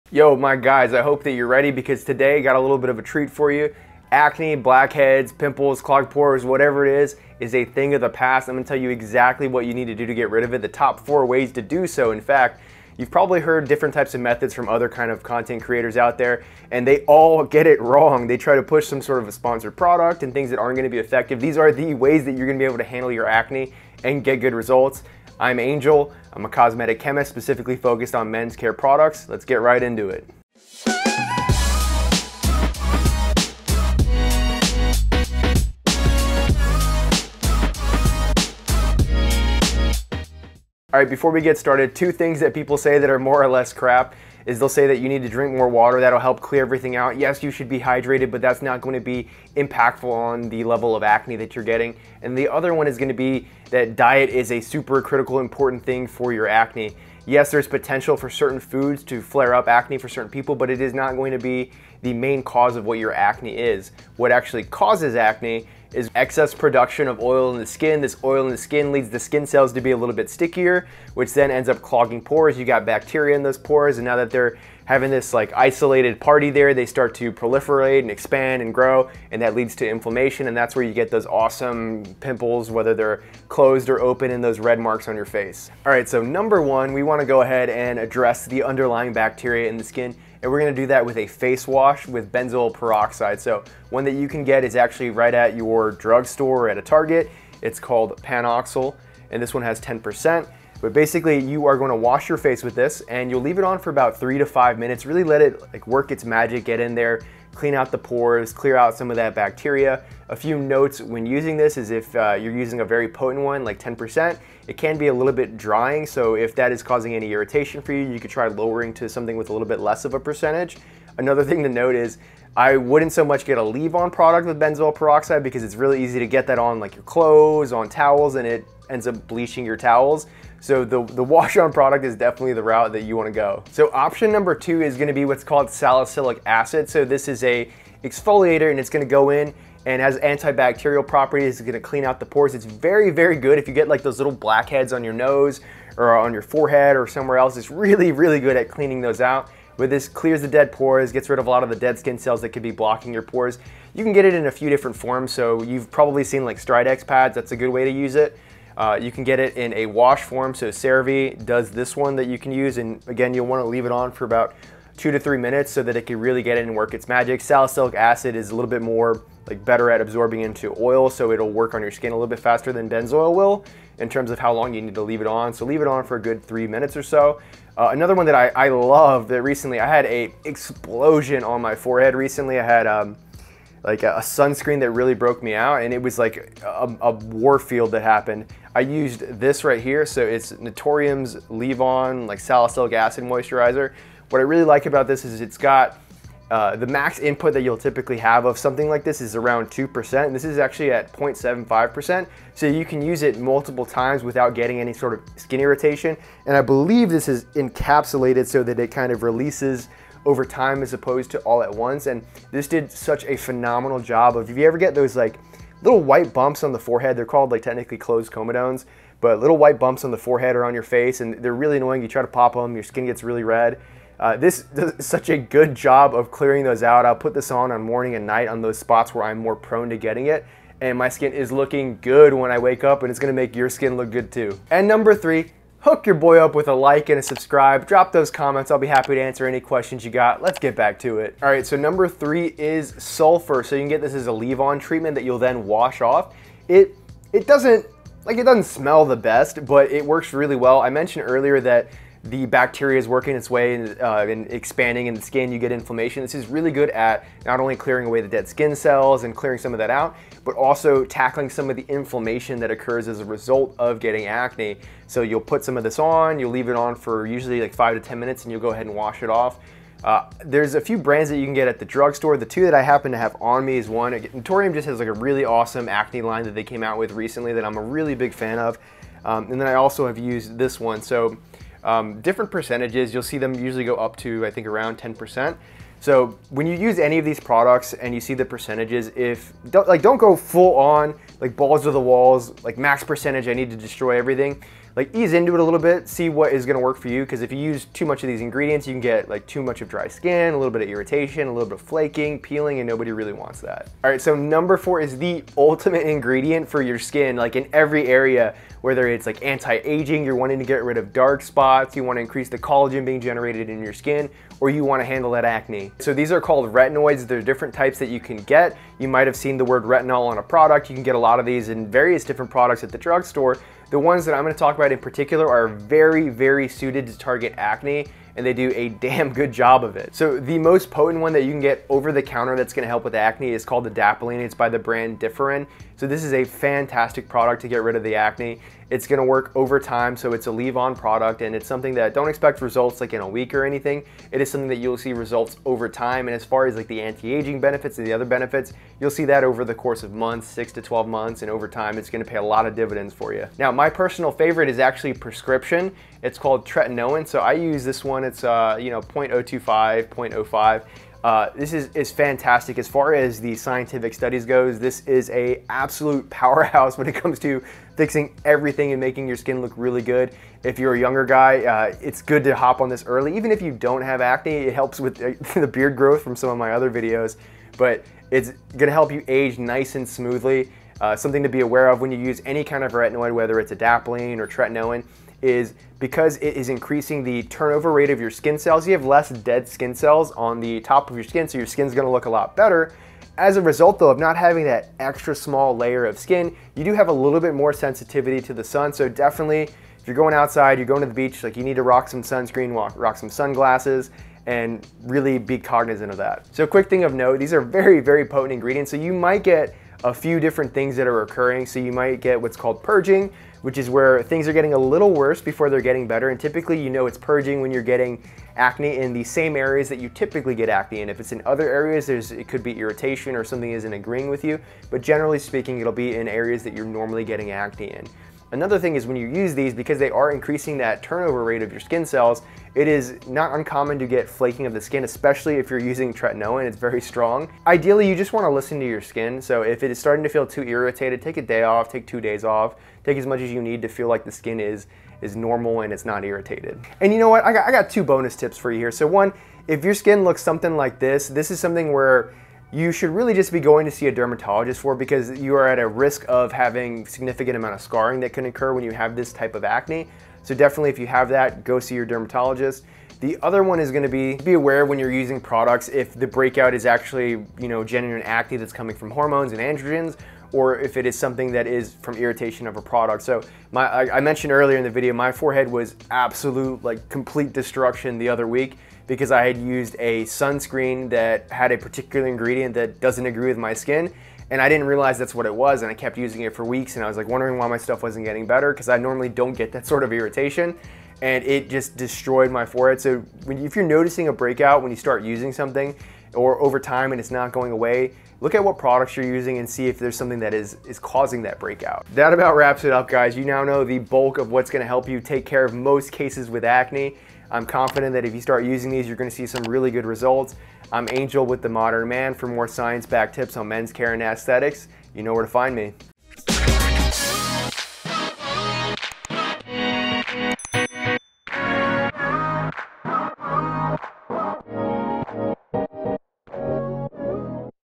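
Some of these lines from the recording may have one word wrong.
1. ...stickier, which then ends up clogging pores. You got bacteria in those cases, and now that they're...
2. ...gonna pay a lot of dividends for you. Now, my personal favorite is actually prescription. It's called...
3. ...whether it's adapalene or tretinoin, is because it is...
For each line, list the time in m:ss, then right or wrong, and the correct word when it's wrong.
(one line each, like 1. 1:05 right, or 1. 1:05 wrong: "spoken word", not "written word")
1. 1:10 wrong: "pores", not "cases"
2. 5:52 right
3. 6:23 right.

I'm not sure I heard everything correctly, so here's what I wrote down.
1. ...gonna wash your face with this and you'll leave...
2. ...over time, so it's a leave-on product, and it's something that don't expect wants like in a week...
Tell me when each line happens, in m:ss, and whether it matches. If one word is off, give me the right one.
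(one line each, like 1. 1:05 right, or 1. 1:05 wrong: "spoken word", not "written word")
1. 1:41 right
2. 5:39 wrong: "results", not "wants".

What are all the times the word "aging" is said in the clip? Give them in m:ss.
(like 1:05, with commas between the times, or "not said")
5:09, 5:46.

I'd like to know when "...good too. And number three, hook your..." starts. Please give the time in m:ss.
3:54.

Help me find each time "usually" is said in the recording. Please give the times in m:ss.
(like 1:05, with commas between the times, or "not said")
4:27, 4:43.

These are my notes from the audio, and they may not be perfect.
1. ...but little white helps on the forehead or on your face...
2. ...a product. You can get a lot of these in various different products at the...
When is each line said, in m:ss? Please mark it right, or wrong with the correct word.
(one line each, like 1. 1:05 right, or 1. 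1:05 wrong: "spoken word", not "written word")
1. 3:39 wrong: "bumps", not "helps"
2. 5:20 right.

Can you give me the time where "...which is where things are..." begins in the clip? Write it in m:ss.
6:53.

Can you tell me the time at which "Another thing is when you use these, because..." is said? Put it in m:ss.
7:08.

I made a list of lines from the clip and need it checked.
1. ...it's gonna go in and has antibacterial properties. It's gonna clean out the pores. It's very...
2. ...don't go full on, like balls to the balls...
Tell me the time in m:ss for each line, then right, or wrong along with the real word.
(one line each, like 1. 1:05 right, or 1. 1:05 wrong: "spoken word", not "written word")
1. 2:18 right
2. 4:50 wrong: "walls", not "balls".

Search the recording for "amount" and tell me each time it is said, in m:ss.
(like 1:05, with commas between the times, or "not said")
7:37.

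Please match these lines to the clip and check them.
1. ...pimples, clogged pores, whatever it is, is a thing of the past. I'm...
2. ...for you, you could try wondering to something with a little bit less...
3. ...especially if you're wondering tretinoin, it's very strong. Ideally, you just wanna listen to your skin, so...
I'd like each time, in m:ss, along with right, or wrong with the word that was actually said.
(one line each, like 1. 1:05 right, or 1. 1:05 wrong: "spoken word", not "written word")
1. 0:05 right
2. 1:57 wrong: "lowering", not "wondering"
3. 7:15 wrong: "using", not "wondering".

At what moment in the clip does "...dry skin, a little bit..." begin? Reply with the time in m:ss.
4:59.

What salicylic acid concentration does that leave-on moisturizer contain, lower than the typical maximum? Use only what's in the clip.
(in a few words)
0.75%.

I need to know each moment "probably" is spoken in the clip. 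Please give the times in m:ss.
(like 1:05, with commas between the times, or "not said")
0:13, 2:35.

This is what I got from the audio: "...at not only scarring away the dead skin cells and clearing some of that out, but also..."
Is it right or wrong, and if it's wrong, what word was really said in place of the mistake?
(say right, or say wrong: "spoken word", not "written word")
wrong: "clearing", not "scarring".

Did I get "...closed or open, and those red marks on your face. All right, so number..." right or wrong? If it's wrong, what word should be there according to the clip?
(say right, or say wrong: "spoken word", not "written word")
right.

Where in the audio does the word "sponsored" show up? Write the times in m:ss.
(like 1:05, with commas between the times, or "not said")
0:19.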